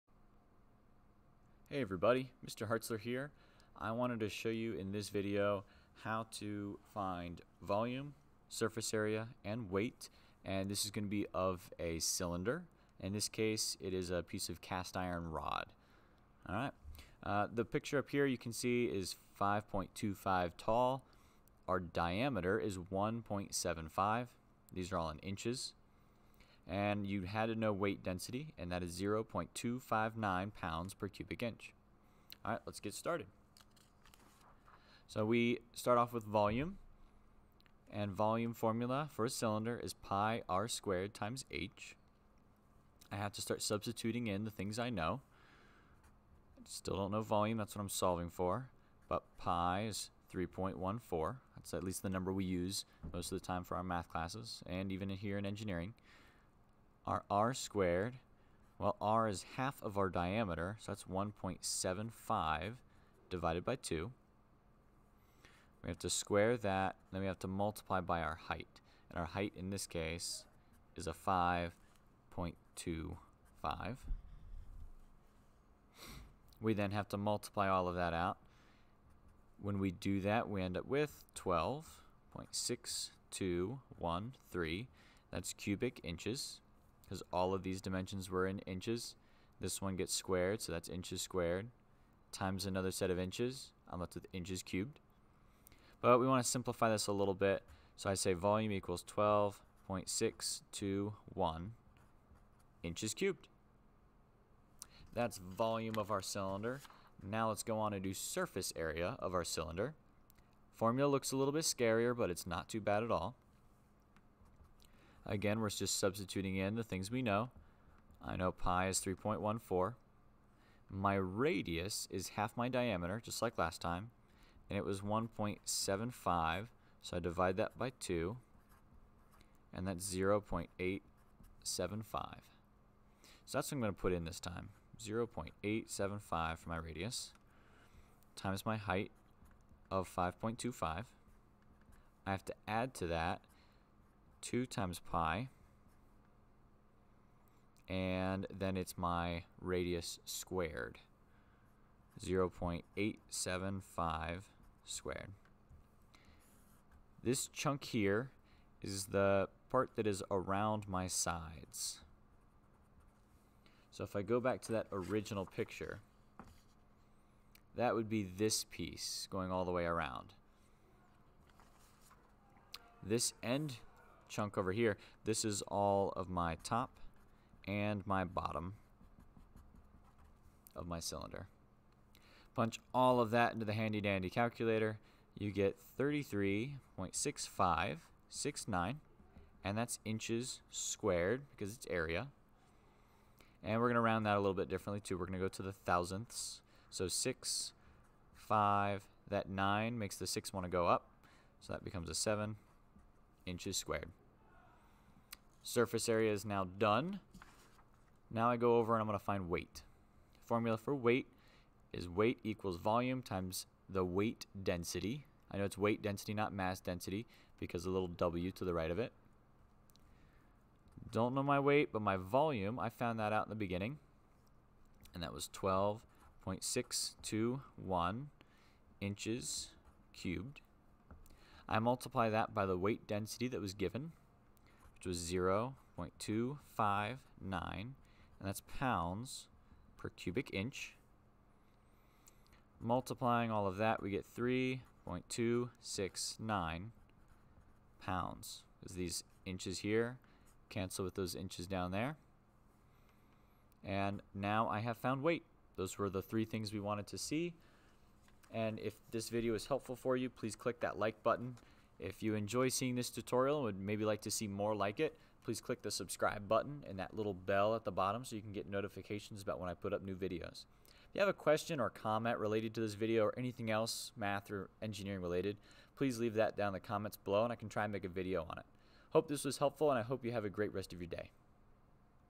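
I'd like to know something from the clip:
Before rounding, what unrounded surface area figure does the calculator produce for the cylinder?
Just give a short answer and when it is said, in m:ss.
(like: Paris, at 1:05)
33.6569, at 3:05.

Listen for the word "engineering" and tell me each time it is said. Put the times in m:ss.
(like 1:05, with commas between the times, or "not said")
0:55, 4:34.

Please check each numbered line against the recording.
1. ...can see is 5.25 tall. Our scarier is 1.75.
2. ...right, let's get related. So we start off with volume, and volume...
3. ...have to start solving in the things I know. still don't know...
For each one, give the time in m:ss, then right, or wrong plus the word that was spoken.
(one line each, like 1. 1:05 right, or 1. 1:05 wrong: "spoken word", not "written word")
1. 0:18 wrong: "diameter", not "scarier"
2. 0:32 wrong: "started", not "related"
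3. 0:43 wrong: "substituting", not "solving".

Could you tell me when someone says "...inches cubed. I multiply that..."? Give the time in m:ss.
3:49.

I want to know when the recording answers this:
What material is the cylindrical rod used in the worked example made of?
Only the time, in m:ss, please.
0:14.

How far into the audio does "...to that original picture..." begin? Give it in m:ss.
2:44.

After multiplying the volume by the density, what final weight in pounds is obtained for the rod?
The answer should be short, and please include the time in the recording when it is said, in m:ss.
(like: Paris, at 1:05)
3.269, at 4:04.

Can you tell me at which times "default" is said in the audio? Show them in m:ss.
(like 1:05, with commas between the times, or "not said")
not said.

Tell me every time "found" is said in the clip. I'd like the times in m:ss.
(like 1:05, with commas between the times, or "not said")
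3:42, 4:14.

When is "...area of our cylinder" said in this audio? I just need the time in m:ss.
1:48.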